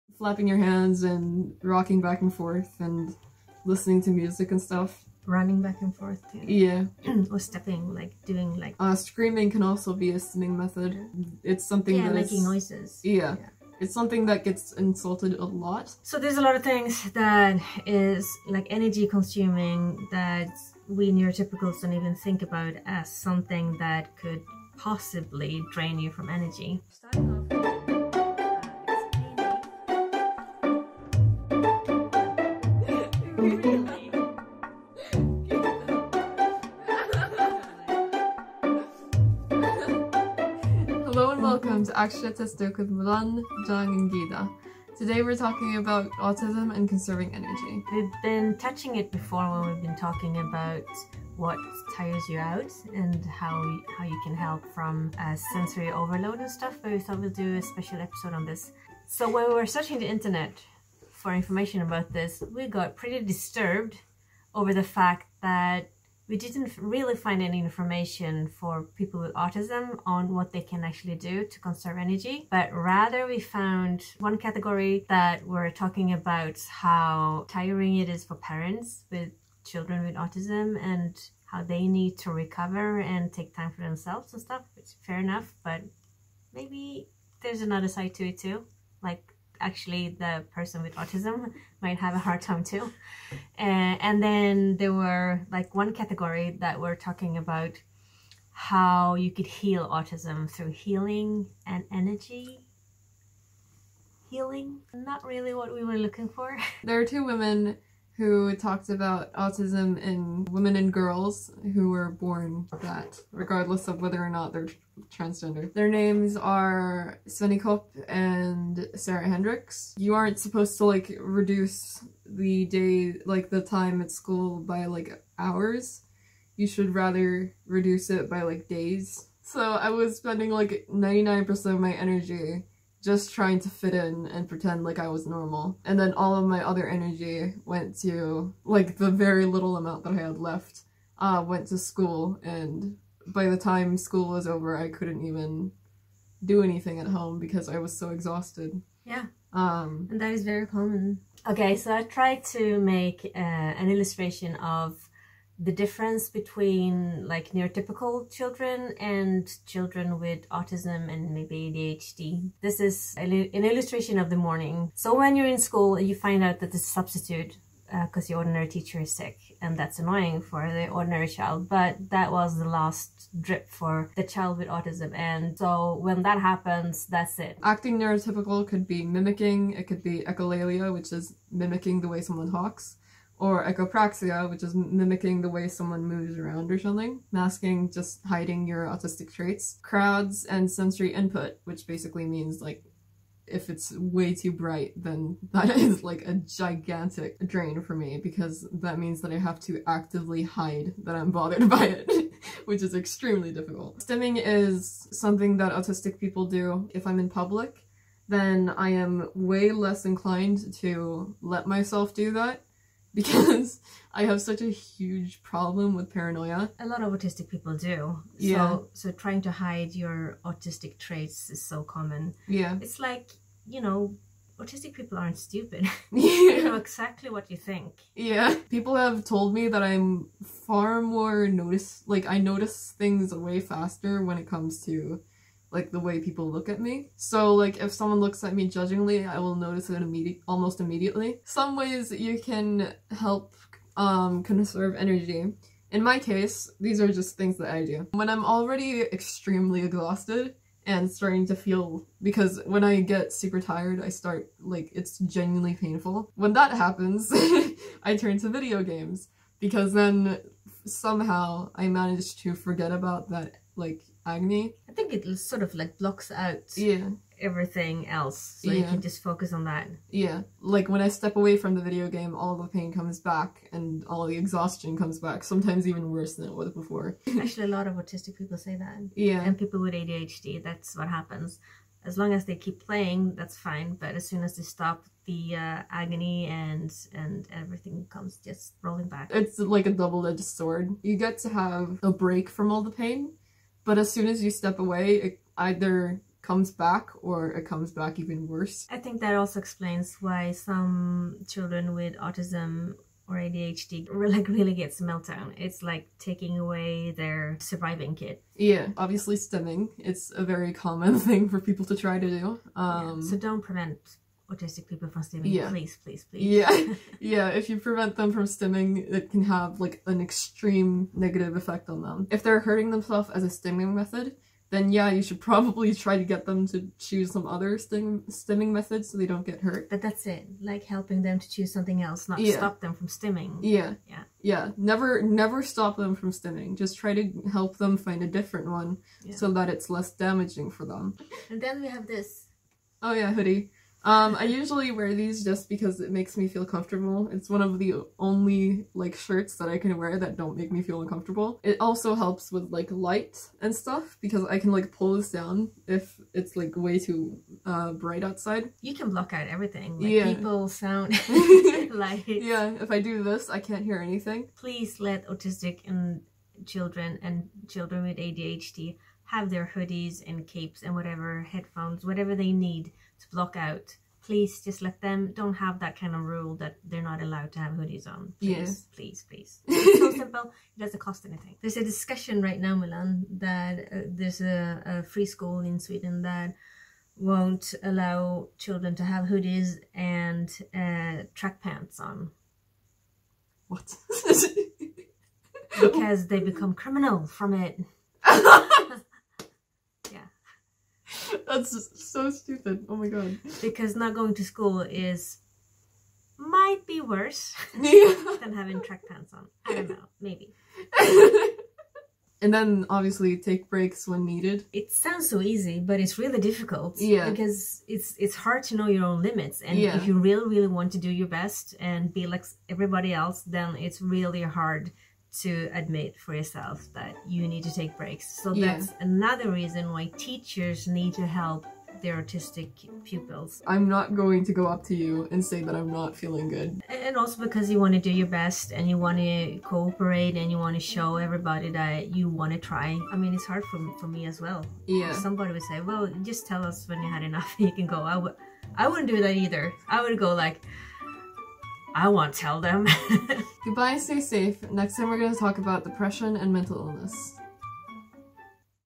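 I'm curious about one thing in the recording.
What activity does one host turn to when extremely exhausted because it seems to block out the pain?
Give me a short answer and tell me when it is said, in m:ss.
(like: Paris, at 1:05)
video games, at 4:18.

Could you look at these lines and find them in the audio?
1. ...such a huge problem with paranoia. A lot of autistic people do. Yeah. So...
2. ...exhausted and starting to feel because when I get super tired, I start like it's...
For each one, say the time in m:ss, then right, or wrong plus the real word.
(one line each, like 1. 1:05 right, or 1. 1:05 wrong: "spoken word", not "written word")
1. 3:34 right
2. 4:09 right.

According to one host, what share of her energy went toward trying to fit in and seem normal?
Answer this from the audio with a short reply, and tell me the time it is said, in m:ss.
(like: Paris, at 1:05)
99%, at 2:10.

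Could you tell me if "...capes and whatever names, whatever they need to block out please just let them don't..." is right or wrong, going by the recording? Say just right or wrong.
wrong.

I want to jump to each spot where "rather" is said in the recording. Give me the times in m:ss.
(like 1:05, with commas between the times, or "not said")
1:12, 2:06.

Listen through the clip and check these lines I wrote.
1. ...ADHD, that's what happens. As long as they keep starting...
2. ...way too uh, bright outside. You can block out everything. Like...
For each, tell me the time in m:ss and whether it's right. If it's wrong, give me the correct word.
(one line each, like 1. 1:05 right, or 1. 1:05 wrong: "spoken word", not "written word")
1. 4:39 wrong: "playing", not "starting"
2. 5:56 right.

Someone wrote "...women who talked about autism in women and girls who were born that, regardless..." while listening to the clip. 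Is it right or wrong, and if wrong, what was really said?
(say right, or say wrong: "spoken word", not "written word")
right.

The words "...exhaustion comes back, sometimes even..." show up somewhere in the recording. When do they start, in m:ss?
4:34.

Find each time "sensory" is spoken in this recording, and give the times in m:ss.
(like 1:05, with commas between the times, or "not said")
0:55, 3:10.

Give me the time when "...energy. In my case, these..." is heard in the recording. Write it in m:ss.
4:04.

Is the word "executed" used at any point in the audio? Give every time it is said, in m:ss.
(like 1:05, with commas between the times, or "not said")
not said.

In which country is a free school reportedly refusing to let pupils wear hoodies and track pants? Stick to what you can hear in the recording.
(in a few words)
Sweden.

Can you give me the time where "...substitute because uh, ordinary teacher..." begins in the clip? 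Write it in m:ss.
2:46.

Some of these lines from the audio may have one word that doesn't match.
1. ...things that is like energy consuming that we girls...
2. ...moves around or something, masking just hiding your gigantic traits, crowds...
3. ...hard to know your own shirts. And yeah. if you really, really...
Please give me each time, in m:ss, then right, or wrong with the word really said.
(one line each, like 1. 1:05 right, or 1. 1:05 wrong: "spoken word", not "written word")
1. 0:16 wrong: "neurotypicals", not "girls"
2. 3:06 wrong: "autistic", not "gigantic"
3. 6:58 wrong: "limits", not "shirts".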